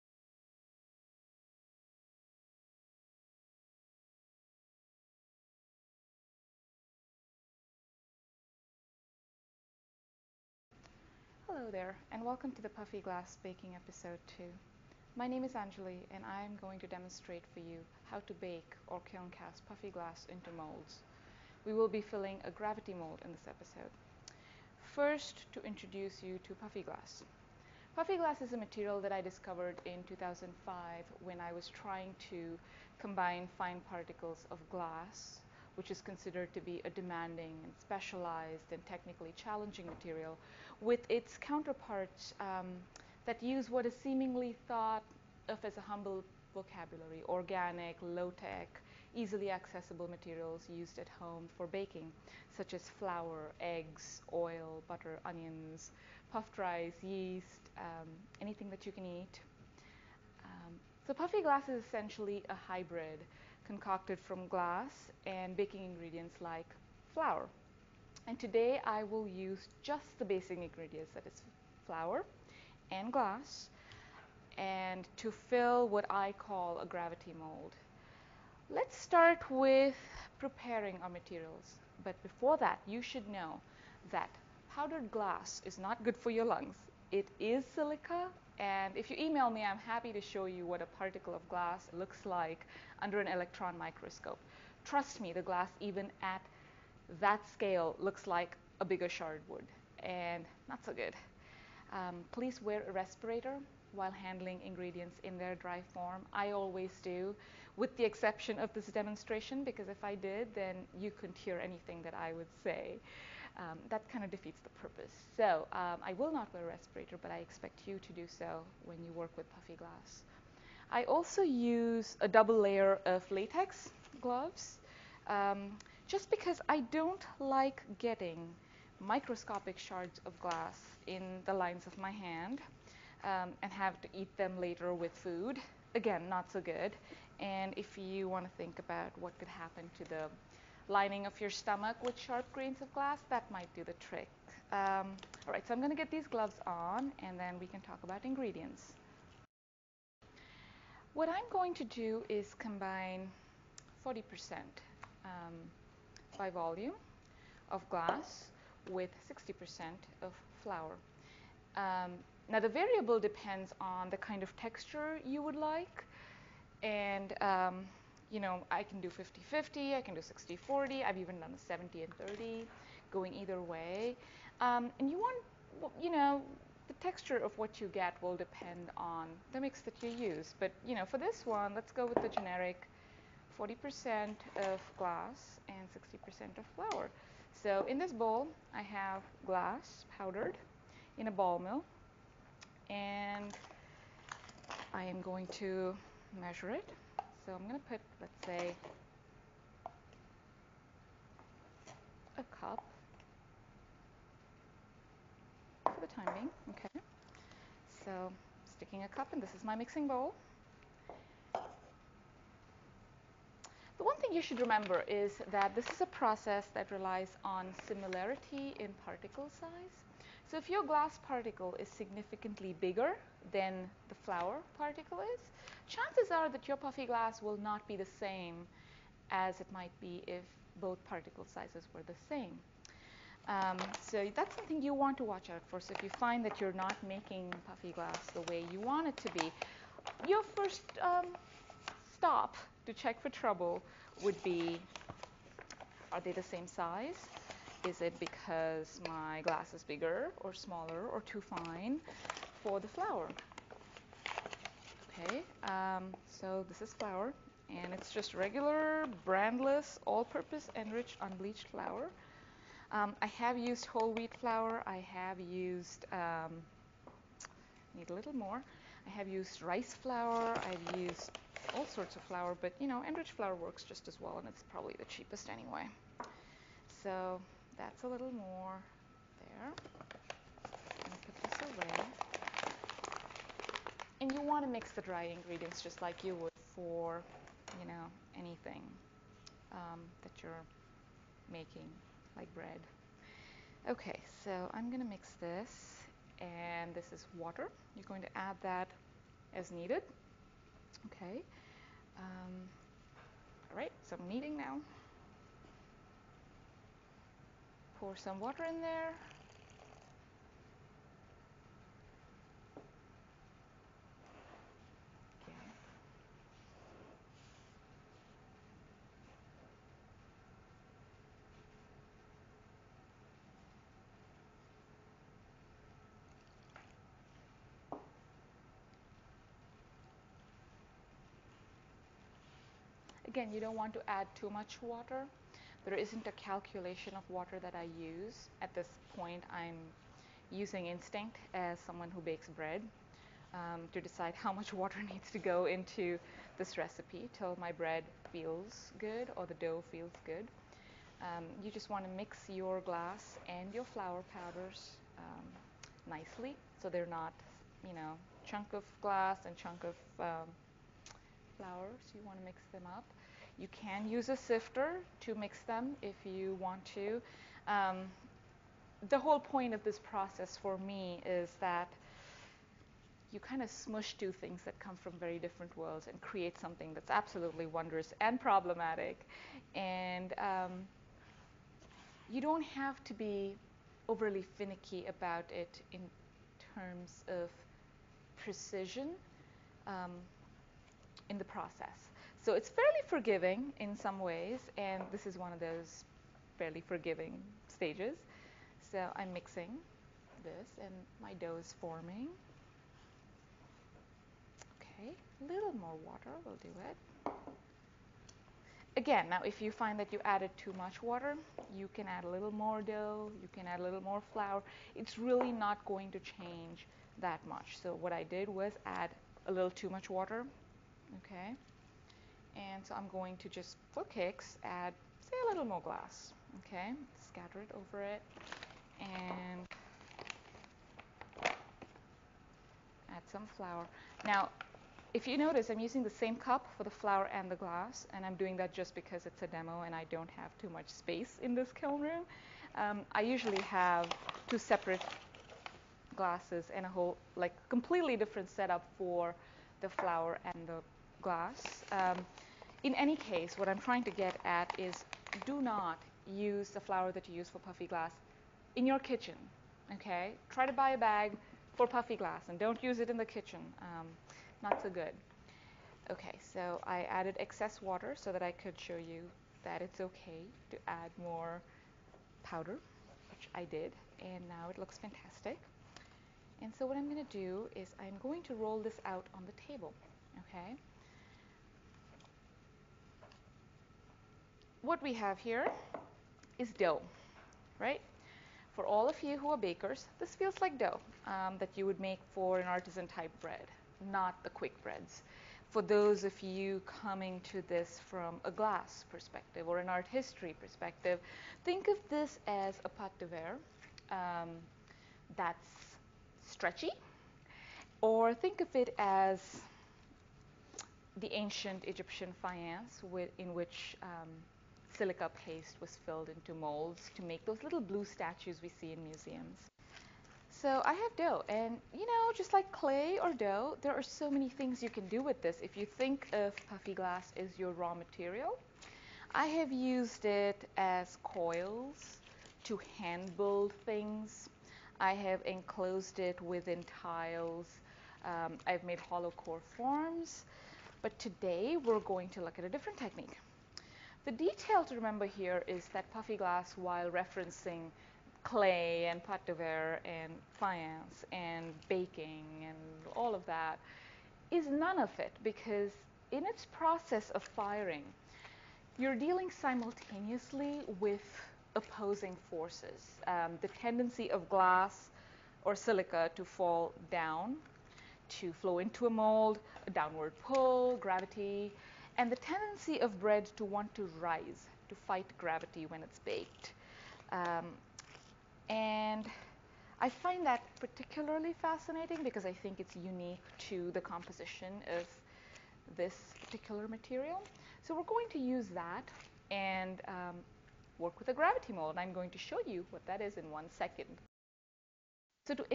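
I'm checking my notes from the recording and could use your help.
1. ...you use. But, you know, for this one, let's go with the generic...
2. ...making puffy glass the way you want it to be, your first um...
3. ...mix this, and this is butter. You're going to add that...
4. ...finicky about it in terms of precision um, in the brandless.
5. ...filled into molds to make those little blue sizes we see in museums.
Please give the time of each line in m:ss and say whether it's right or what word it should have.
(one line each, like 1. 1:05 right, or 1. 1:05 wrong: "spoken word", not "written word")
1. 3:00 right
2. 3:57 right
3. 4:55 wrong: "water", not "butter"
4. 6:24 wrong: "process", not "brandless"
5. 8:36 wrong: "statues", not "sizes".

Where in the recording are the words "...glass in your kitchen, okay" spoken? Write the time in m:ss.
7:37.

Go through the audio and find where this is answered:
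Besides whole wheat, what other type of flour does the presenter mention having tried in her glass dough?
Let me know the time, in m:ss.
4:29.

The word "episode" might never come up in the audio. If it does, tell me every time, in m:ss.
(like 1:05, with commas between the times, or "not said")
0:13, 0:23.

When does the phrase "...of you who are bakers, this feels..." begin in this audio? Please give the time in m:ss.
8:09.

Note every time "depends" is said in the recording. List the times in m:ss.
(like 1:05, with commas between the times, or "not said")
2:43, 2:58.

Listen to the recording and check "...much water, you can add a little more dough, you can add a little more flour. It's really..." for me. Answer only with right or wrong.
right.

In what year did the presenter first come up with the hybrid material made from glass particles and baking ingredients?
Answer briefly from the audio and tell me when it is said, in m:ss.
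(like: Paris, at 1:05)
2005, at 0:30.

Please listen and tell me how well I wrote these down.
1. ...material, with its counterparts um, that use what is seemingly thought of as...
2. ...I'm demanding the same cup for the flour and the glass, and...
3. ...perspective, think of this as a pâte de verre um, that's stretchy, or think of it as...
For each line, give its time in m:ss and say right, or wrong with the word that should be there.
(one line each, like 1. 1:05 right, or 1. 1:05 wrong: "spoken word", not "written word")
1. 0:39 right
2. 7:15 wrong: "using", not "demanding"
3. 8:20 right.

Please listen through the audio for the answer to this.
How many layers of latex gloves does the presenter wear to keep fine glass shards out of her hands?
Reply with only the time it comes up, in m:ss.
2:02.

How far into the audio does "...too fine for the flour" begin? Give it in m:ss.
4:11.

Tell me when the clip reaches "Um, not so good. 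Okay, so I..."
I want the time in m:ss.
7:43.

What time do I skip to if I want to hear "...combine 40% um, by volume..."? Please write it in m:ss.
2:32.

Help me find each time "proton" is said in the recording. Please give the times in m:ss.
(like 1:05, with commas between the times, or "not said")
not said.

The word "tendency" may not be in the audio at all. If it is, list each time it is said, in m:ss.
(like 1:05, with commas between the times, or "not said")
9:23, 9:32.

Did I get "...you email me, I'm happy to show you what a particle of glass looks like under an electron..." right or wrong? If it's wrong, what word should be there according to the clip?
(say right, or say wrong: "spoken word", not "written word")
right.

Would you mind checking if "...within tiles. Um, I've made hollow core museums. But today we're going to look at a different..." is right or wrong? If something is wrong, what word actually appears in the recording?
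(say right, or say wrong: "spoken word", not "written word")
wrong: "forms", not "museums".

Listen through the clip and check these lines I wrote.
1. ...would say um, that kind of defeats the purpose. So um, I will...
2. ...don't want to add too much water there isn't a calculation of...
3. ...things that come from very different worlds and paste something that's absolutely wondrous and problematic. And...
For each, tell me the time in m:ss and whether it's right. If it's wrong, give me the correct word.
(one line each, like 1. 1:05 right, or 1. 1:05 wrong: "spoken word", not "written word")
1. 1:52 right
2. 5:33 right
3. 6:14 wrong: "create", not "paste".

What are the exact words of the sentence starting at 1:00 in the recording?
Um, so puffy glass is essentially a hybrid concocted from glass and baking ingredients like flour.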